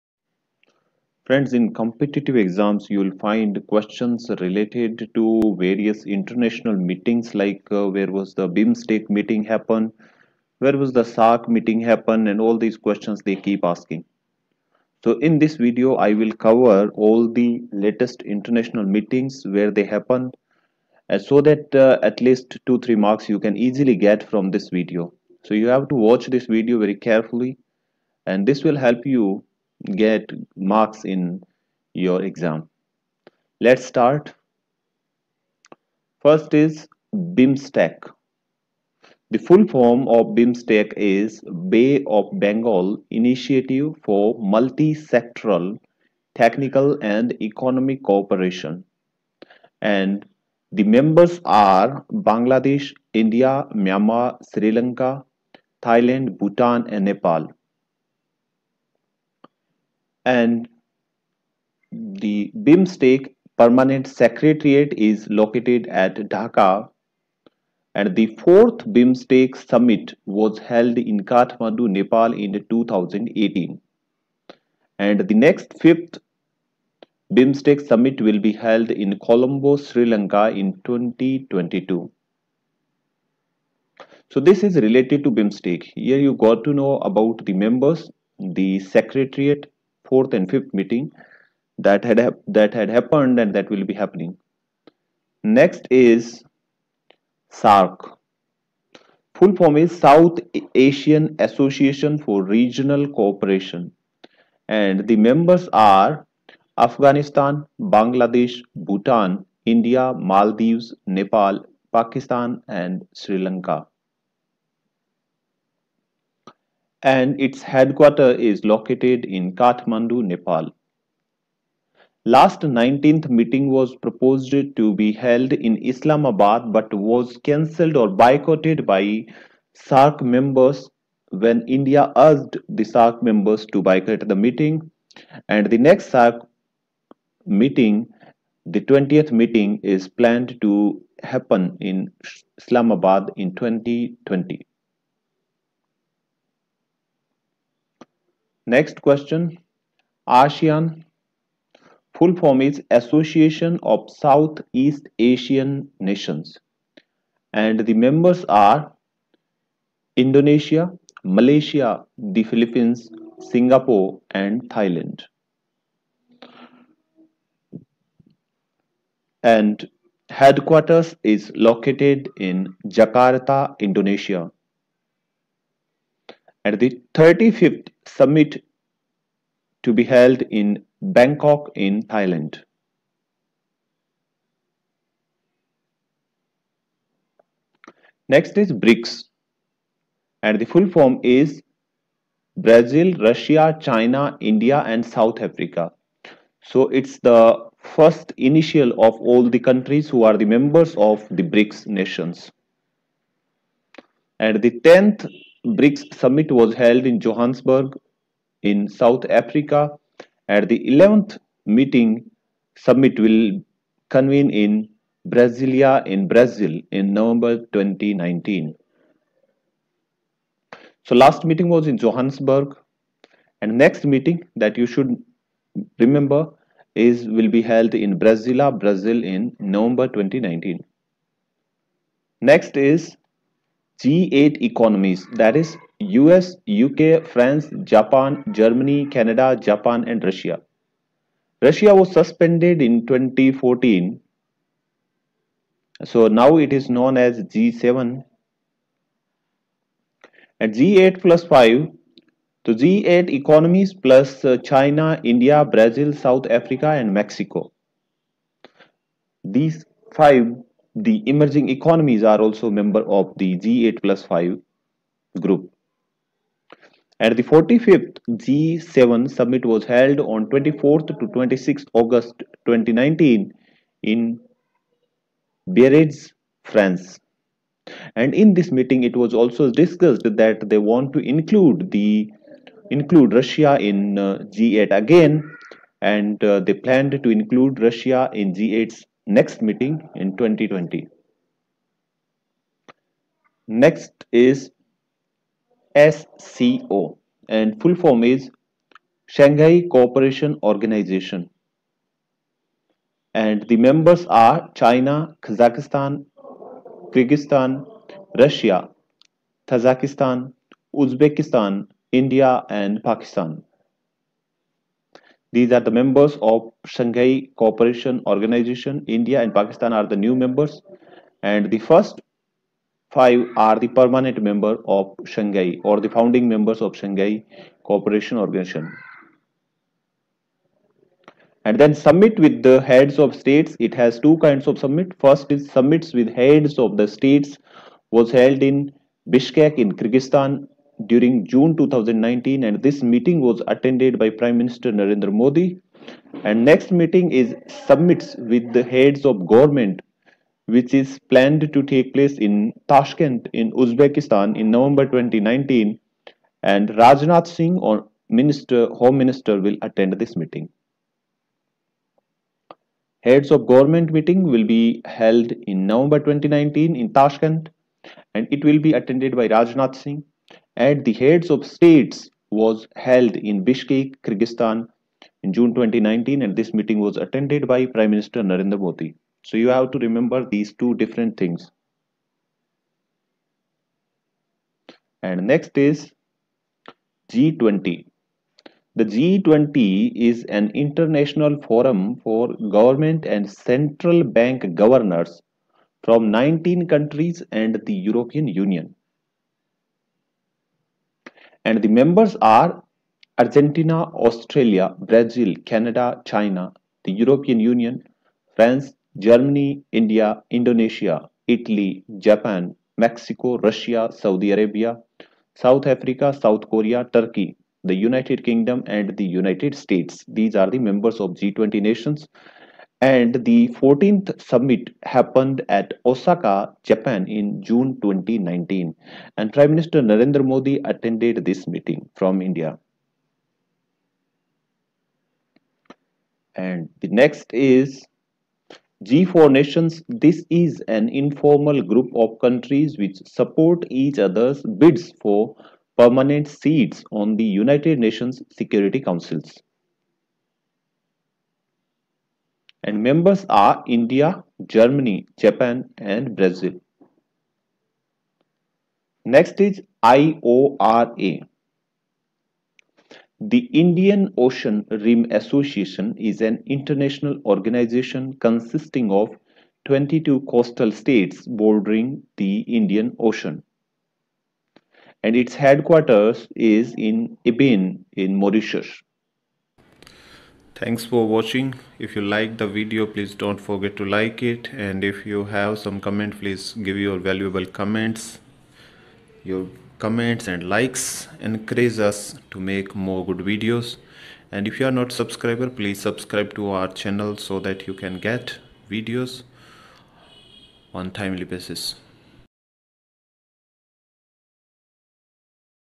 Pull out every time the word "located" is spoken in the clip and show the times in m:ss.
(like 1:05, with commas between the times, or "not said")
1:05, 1:58, 2:51.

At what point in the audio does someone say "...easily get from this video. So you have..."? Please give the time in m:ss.
0:23.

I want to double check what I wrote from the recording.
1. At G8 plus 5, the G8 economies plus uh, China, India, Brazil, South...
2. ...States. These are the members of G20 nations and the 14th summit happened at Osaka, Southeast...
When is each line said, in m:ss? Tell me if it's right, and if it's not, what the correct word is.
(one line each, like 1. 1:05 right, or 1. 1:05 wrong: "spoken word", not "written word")
1. 4:10 right
2. 6:59 wrong: "Japan", not "Southeast".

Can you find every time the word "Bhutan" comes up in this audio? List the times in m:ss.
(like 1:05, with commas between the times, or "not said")
0:56, 1:48.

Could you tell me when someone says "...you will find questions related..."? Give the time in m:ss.
0:02.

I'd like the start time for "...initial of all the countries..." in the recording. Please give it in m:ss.
3:18.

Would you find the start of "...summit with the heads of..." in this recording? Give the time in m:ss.
5:31.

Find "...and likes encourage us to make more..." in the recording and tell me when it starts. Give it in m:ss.
8:10.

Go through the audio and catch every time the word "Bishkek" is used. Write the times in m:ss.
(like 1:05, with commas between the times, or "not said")
5:39, 6:13.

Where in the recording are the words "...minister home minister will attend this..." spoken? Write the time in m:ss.
5:58.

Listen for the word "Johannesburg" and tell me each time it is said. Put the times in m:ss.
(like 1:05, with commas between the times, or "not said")
3:27, 3:41.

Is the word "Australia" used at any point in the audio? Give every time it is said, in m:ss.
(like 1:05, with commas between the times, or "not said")
6:44.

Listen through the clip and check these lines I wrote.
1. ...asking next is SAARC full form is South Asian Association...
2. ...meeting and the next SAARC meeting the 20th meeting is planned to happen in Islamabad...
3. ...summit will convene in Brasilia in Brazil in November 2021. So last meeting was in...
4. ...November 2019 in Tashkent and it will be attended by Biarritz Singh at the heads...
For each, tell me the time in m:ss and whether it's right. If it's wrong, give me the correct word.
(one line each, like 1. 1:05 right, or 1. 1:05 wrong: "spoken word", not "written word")
1. 1:33 wrong: "happening", not "asking"
2. 2:14 right
3. 3:32 wrong: "2019", not "2021"
4. 6:05 wrong: "Rajnath", not "Biarritz".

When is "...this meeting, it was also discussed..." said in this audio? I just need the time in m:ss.
4:38.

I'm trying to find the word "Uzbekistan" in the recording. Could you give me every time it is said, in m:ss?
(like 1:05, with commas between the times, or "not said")
5:10, 5:53.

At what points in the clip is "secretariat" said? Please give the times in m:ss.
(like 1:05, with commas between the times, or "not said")
1:04, 1:28.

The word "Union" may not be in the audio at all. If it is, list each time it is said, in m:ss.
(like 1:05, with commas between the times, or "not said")
6:38, 6:47.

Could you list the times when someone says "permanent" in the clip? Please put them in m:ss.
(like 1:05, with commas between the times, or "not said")
1:03, 5:23, 7:25.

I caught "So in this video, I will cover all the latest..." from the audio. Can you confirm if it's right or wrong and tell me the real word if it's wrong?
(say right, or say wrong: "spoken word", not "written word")
right.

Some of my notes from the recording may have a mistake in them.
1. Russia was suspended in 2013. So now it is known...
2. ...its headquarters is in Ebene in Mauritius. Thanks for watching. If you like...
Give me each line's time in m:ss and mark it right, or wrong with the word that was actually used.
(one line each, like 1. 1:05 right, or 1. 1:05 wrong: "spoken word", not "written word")
1. 4:01 wrong: "2014", not "2013"
2. 7:55 right.